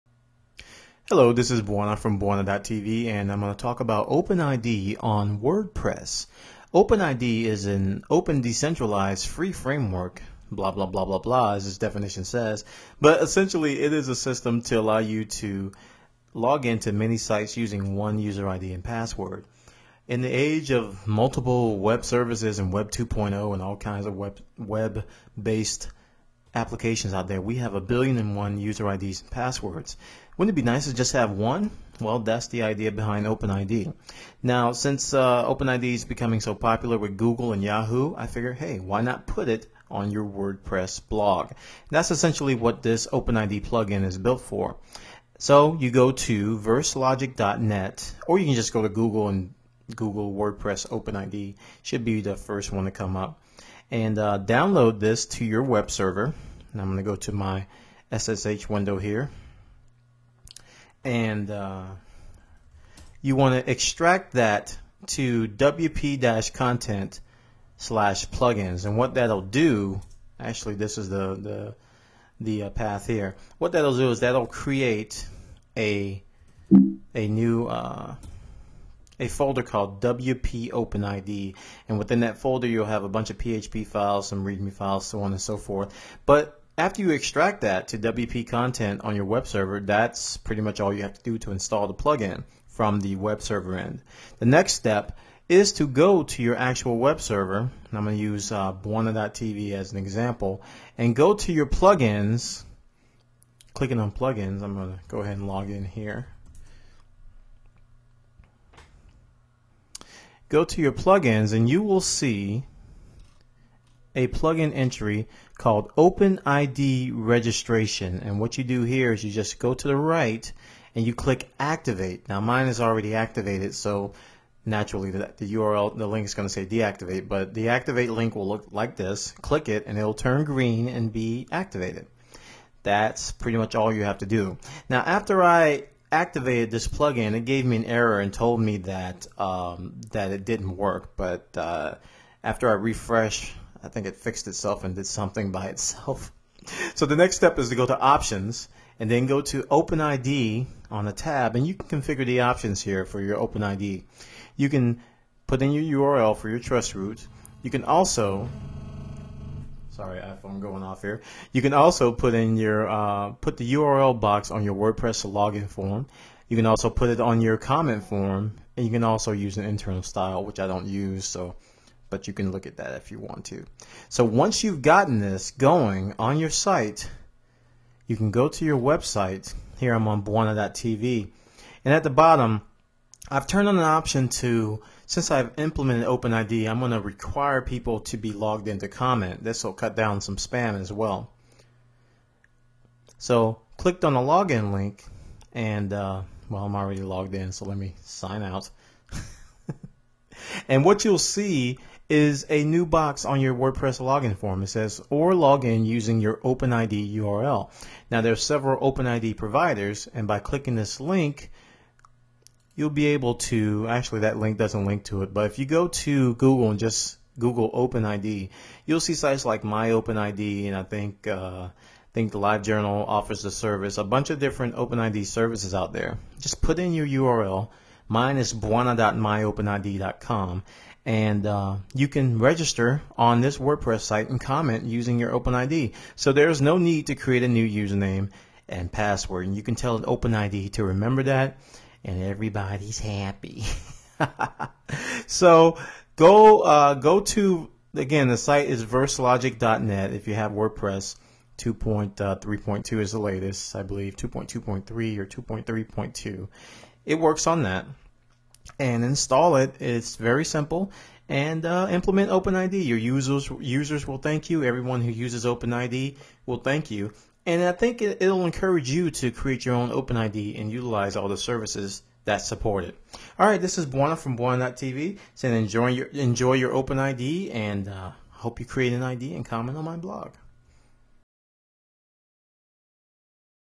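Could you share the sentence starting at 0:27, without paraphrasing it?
We have a billion and one user IDs and passwords.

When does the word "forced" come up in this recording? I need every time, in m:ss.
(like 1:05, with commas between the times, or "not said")
not said.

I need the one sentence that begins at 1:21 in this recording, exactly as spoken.
And within that folder, you'll have a bunch of PHP files, some README files, so on and so forth.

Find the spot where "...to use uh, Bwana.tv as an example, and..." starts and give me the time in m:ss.
1:38.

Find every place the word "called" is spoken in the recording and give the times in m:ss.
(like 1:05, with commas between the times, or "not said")
1:19, 1:55.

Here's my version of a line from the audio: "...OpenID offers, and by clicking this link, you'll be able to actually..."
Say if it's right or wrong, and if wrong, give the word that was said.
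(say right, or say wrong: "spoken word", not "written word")
wrong: "providers", not "offers".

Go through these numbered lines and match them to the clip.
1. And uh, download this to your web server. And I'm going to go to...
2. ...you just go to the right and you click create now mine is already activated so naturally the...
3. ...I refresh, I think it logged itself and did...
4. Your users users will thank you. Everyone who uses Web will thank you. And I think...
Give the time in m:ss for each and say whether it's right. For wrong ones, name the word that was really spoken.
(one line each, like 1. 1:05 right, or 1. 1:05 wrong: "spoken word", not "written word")
1. 0:53 right
2. 1:59 wrong: "activate", not "create"
3. 2:22 wrong: "fixed", not "logged"
4. 4:22 wrong: "OpenID", not "Web".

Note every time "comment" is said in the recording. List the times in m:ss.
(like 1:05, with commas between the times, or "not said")
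2:47, 3:08, 3:54, 4:39.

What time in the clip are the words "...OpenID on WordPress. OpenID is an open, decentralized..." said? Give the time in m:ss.
0:04.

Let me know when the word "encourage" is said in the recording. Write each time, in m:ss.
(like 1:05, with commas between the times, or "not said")
4:28.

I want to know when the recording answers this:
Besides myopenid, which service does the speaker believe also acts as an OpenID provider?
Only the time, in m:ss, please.
3:42.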